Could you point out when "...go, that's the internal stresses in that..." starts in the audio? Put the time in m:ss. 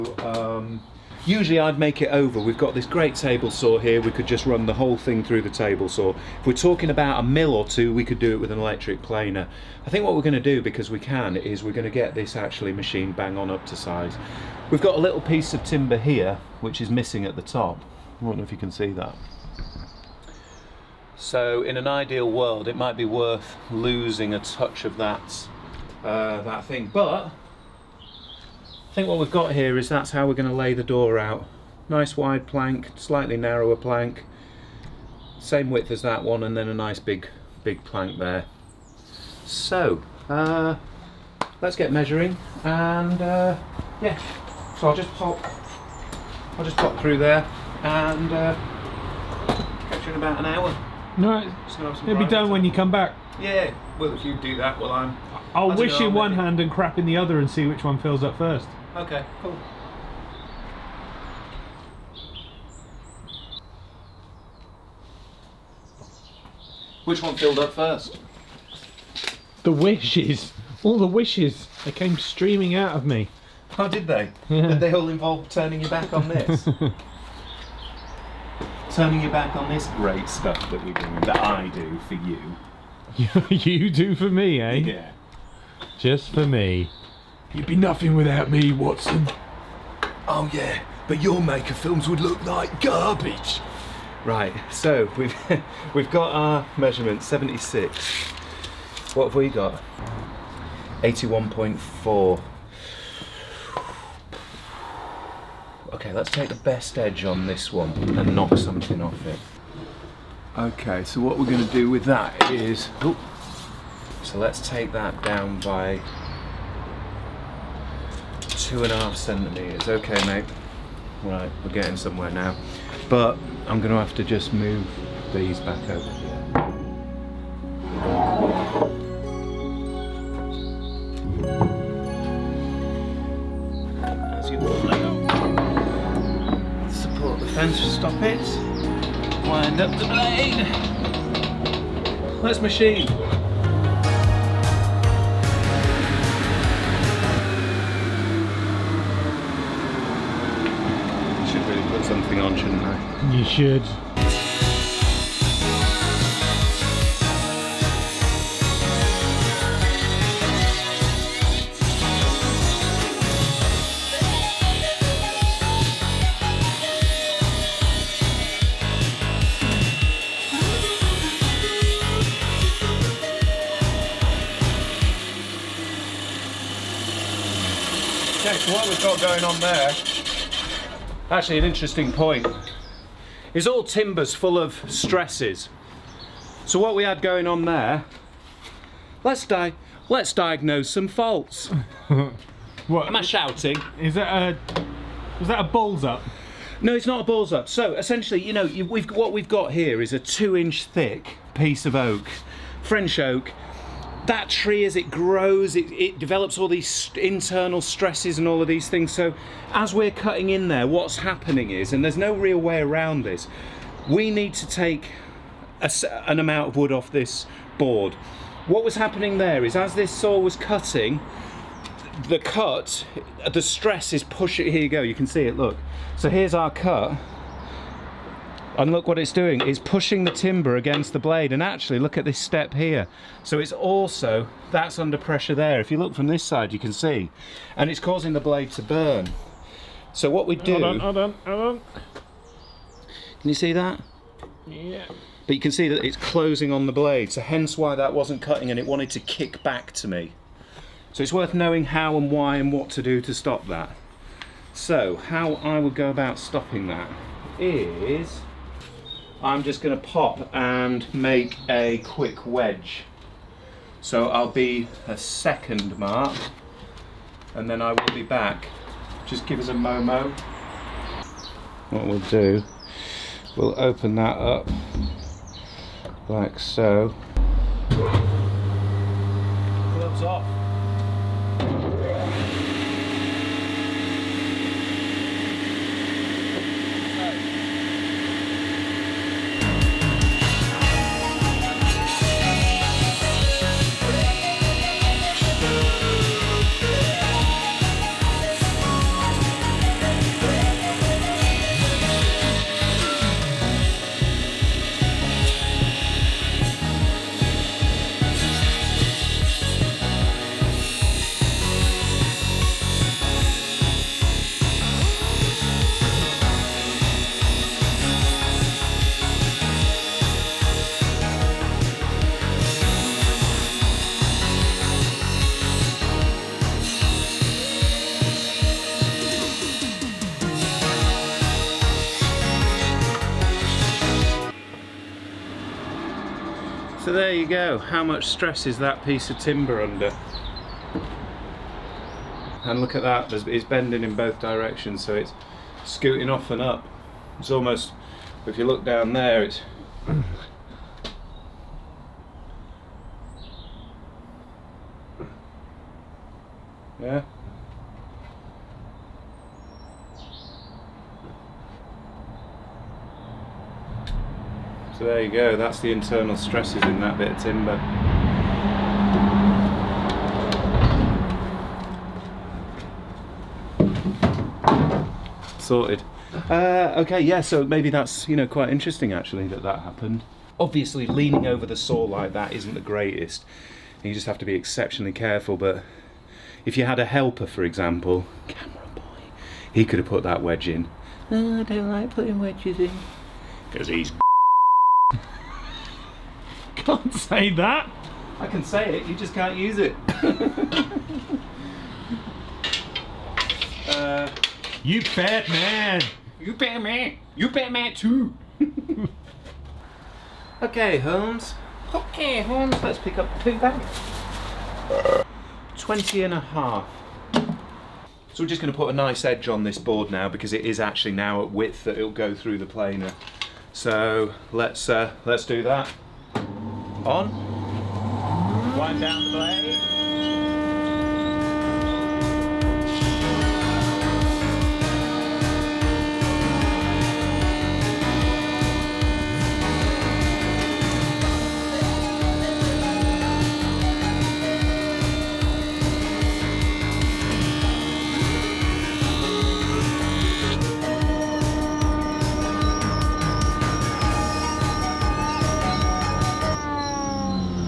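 6:05.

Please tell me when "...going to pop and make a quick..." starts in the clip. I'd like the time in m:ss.
4:19.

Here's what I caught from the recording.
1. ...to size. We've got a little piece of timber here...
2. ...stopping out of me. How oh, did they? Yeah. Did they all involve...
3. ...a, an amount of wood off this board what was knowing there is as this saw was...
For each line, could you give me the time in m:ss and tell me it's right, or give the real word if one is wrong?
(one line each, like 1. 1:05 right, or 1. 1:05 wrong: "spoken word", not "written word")
1. 0:13 right
2. 1:12 wrong: "streaming", not "stopping"
3. 3:35 wrong: "happening", not "knowing".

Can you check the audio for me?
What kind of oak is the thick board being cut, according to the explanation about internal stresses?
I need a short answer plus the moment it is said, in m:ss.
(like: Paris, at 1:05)
French oak, at 3:22.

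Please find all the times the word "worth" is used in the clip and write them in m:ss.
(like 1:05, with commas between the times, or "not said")
0:23, 4:11.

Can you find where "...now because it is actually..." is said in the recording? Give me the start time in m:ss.
7:00.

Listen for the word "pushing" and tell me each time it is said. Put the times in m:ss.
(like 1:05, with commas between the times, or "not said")
3:44, 3:49.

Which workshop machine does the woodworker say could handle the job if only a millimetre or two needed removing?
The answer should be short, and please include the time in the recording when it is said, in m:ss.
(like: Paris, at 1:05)
Electric planer, at 0:08.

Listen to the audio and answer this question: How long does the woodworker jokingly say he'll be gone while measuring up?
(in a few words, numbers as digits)
About an hour.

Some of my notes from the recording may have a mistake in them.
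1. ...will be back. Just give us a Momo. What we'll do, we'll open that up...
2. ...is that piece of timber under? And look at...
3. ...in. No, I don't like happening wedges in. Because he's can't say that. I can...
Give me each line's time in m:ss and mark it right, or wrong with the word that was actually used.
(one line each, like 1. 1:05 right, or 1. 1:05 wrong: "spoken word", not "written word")
1. 4:27 right
2. 5:38 right
3. 6:30 wrong: "putting", not "happening".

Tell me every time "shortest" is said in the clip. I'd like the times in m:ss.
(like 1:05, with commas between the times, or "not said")
not said.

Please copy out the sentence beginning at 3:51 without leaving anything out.
And actually, look at this step here.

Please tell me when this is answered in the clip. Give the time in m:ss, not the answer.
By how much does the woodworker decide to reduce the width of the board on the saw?
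1:58.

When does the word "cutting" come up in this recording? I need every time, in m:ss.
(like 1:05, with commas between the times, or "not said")
3:30, 3:40, 4:08.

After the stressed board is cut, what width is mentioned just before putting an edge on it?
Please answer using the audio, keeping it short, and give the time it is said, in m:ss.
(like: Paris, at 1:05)
20.5, at 6:55.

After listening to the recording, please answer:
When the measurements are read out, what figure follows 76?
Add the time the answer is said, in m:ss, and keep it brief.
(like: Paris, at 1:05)
81.4, at 1:41.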